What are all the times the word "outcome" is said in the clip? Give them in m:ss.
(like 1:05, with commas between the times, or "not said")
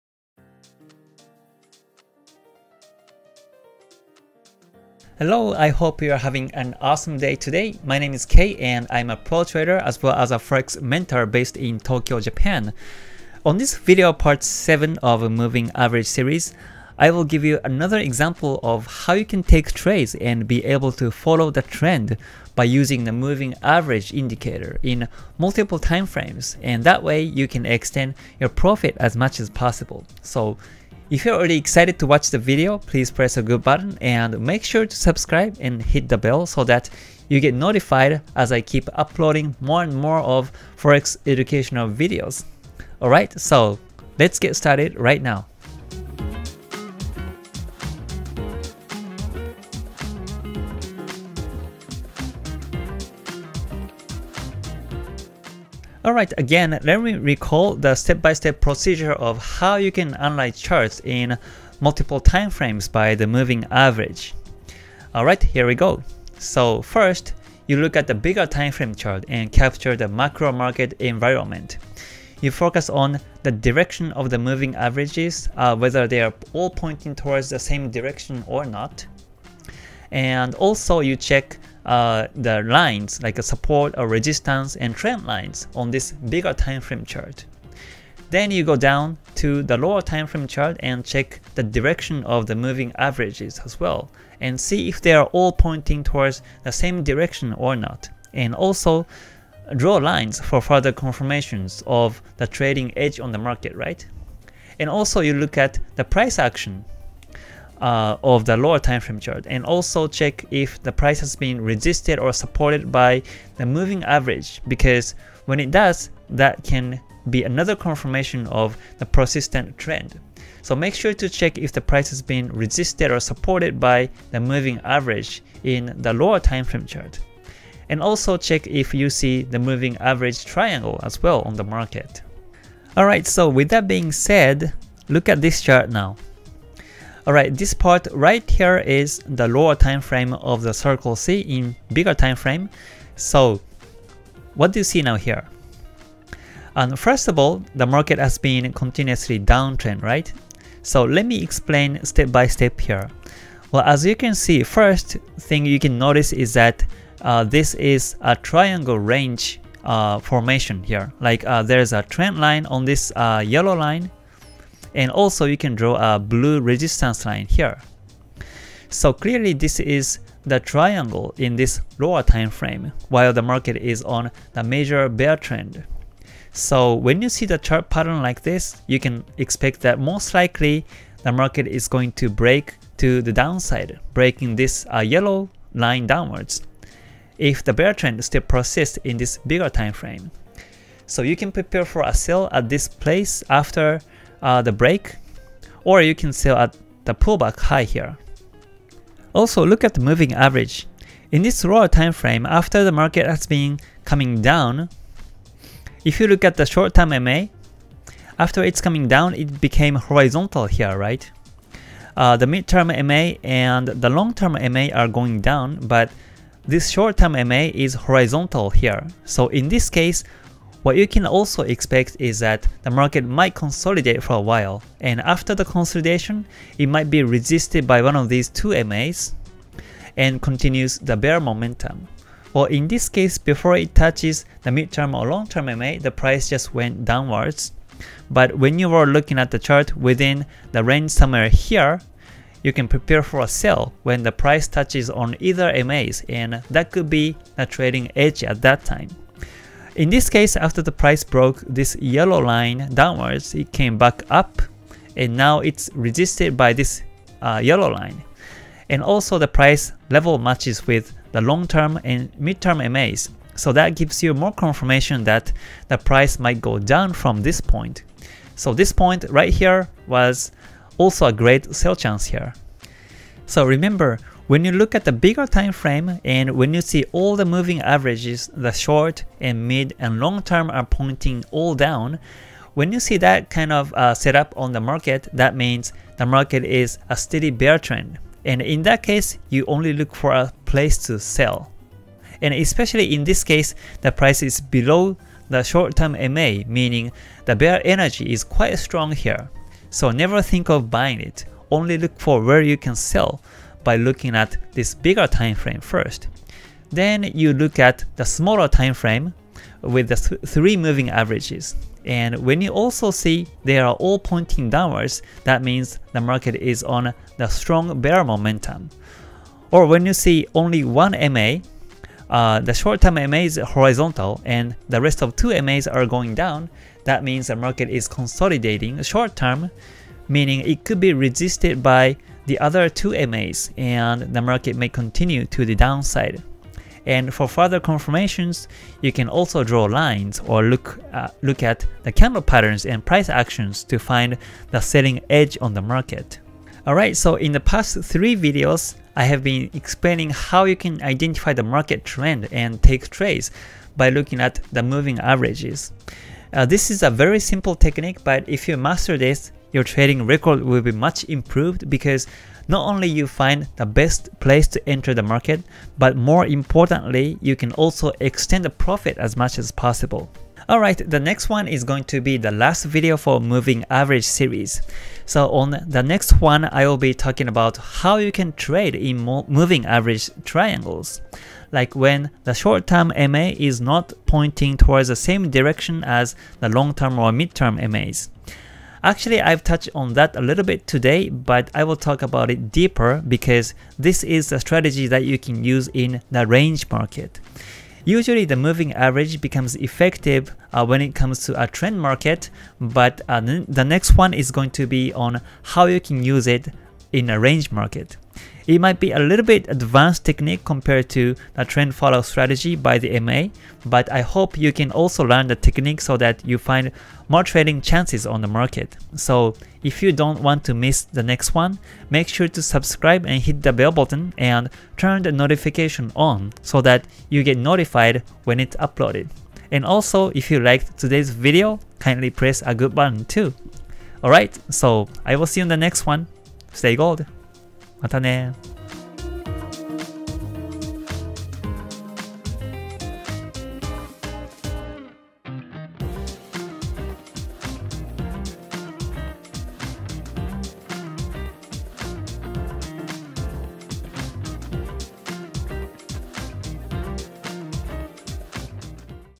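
not said.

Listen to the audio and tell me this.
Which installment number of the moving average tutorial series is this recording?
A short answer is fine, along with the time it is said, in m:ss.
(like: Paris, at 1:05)
7, at 0:14.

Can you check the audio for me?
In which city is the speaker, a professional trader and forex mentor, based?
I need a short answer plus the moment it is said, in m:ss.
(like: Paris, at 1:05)
Tokyo, at 0:11.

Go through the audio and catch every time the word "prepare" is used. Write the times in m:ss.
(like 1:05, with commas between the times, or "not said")
3:11, 4:02.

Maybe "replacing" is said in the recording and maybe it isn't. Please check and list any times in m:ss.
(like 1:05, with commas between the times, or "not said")
not said.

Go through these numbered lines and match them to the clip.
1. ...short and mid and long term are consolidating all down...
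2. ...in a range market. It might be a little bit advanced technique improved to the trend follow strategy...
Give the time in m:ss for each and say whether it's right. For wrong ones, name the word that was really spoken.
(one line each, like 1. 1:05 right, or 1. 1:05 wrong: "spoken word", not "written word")
1. 4:38 wrong: "pointing", not "consolidating"
2. 6:47 wrong: "compared", not "improved".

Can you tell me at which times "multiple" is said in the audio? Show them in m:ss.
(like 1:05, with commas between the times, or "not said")
0:25, 1:01.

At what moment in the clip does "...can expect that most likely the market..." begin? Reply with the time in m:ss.
2:58.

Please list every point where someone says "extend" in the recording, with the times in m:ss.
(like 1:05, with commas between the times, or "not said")
0:27, 6:08.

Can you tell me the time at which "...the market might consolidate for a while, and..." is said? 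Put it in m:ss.
3:42.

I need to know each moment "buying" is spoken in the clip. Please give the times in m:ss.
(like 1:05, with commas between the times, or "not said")
5:00.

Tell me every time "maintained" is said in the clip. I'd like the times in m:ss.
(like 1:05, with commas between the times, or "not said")
not said.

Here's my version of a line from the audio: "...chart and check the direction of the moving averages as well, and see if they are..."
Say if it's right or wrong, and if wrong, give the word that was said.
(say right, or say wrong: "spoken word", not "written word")
right.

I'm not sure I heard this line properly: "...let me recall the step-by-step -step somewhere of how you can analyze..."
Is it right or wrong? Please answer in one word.
wrong.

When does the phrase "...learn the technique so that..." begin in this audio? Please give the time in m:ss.
6:55.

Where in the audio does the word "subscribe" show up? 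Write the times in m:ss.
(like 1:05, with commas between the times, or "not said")
0:34, 7:02.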